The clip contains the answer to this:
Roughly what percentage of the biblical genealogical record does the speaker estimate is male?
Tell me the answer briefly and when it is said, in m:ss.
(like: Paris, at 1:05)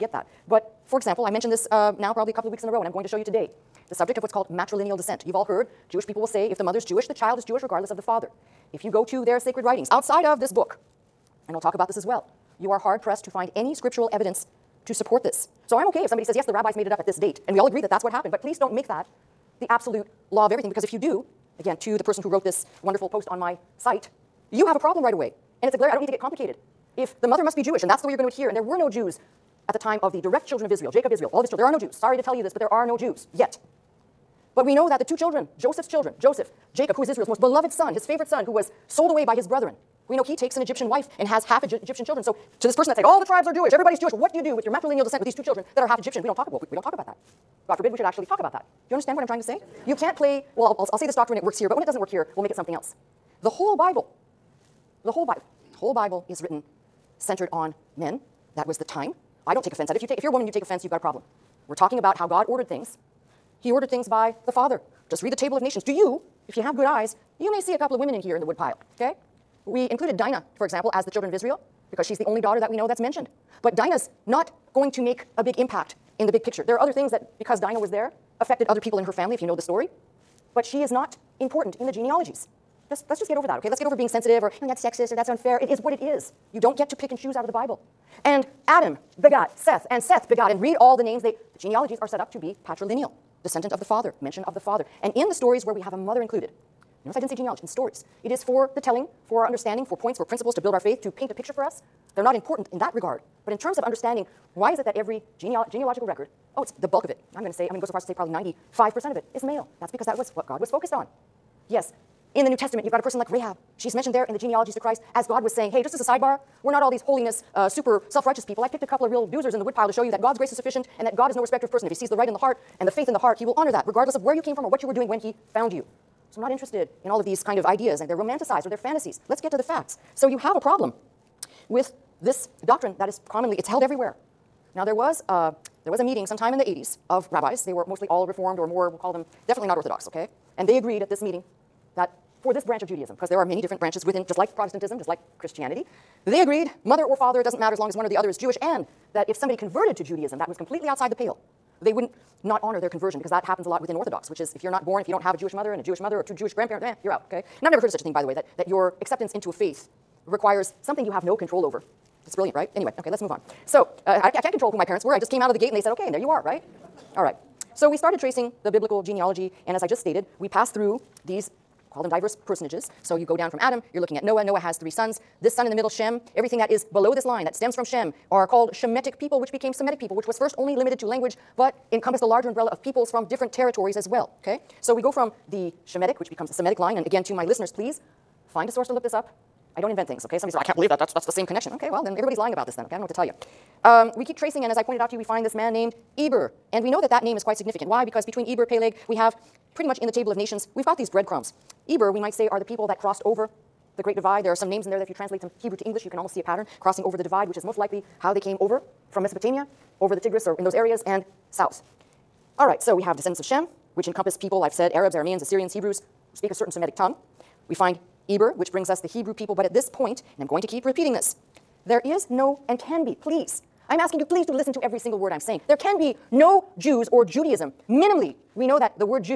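95%, at 1:48.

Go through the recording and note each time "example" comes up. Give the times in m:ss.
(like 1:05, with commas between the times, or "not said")
0:00, 1:10.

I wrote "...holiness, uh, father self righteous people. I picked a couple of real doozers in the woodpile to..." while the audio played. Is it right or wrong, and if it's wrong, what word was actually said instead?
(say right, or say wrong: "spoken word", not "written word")
wrong: "super", not "father".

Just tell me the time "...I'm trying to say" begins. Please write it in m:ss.
0:49.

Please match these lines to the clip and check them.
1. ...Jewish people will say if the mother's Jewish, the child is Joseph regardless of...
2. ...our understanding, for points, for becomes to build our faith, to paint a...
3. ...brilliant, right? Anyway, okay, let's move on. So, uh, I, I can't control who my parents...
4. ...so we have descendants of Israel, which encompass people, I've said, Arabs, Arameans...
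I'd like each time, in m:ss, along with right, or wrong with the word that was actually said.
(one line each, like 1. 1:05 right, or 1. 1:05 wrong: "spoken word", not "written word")
1. 0:05 wrong: "Jewish", not "Joseph"
2. 1:39 wrong: "principles", not "becomes"
3. 2:42 right
4. 3:32 wrong: "Shem", not "Israel".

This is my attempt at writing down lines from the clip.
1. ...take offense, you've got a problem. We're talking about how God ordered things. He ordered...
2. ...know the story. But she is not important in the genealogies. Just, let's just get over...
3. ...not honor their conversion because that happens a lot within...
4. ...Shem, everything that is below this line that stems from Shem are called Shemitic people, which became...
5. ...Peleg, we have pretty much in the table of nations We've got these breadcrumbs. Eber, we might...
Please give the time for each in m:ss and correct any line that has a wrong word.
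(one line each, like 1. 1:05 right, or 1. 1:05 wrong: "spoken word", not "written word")
1. 1:00 right
2. 1:19 right
3. 2:32 right
4. 2:55 right
5. 3:18 right.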